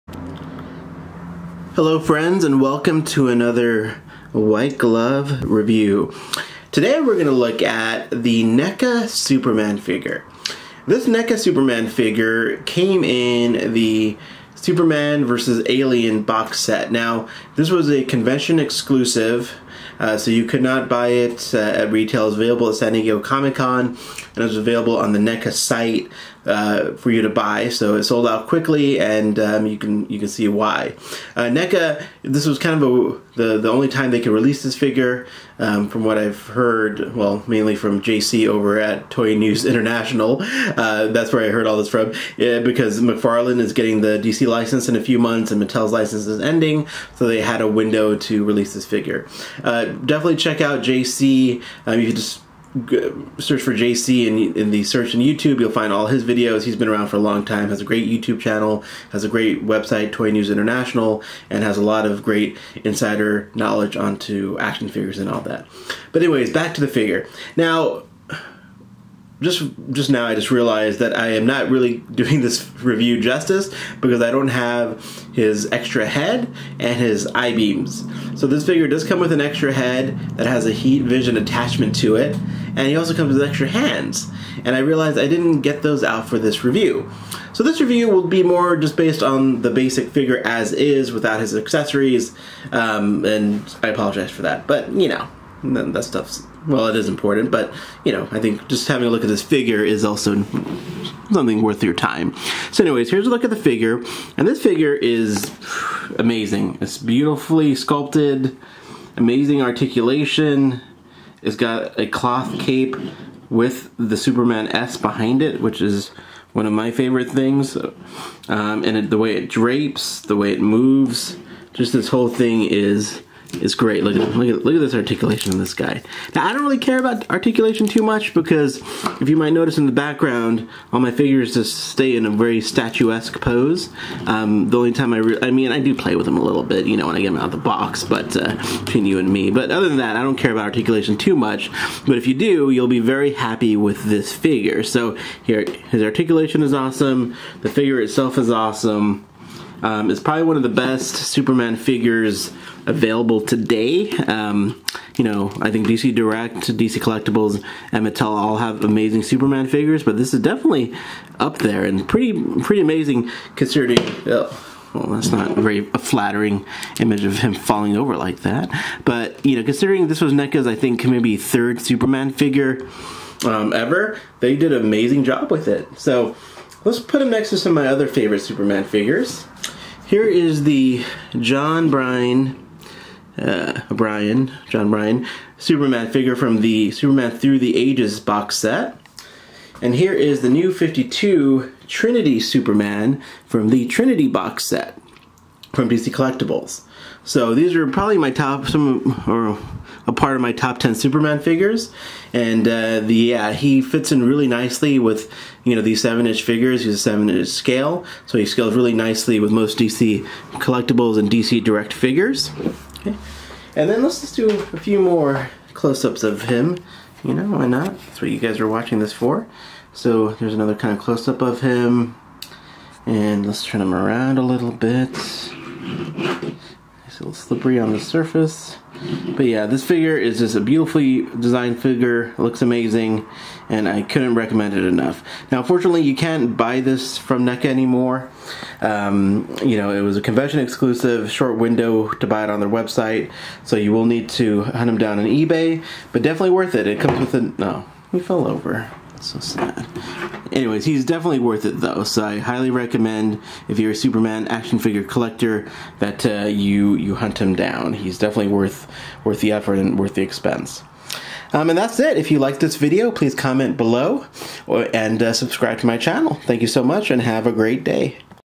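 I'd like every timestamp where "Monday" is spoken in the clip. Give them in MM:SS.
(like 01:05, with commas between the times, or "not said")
not said.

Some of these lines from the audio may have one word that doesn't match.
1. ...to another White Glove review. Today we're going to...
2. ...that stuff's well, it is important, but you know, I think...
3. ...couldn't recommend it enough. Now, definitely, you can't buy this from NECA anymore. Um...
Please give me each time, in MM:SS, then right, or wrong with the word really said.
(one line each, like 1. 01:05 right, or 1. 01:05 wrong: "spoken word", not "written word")
1. 00:03 right
2. 01:35 right
3. 03:54 wrong: "fortunately", not "definitely".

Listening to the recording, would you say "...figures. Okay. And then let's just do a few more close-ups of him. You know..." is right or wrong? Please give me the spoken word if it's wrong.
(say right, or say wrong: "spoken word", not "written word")
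right.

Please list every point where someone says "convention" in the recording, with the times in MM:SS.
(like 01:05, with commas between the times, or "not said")
00:18, 04:00.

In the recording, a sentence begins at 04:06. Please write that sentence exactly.
It comes with a, no, We he fell over.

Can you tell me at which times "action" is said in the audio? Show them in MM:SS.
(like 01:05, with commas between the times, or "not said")
01:04, 04:14.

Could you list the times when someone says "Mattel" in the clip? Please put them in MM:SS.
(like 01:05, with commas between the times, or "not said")
00:45, 02:38.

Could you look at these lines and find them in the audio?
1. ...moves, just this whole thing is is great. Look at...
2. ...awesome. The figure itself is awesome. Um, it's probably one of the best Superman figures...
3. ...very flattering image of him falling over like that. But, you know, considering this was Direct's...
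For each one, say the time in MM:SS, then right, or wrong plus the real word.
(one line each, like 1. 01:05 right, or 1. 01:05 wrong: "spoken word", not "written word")
1. 02:00 right
2. 02:26 right
3. 02:45 wrong: "NECA", not "Direct".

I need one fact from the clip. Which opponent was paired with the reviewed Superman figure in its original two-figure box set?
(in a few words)
Alien.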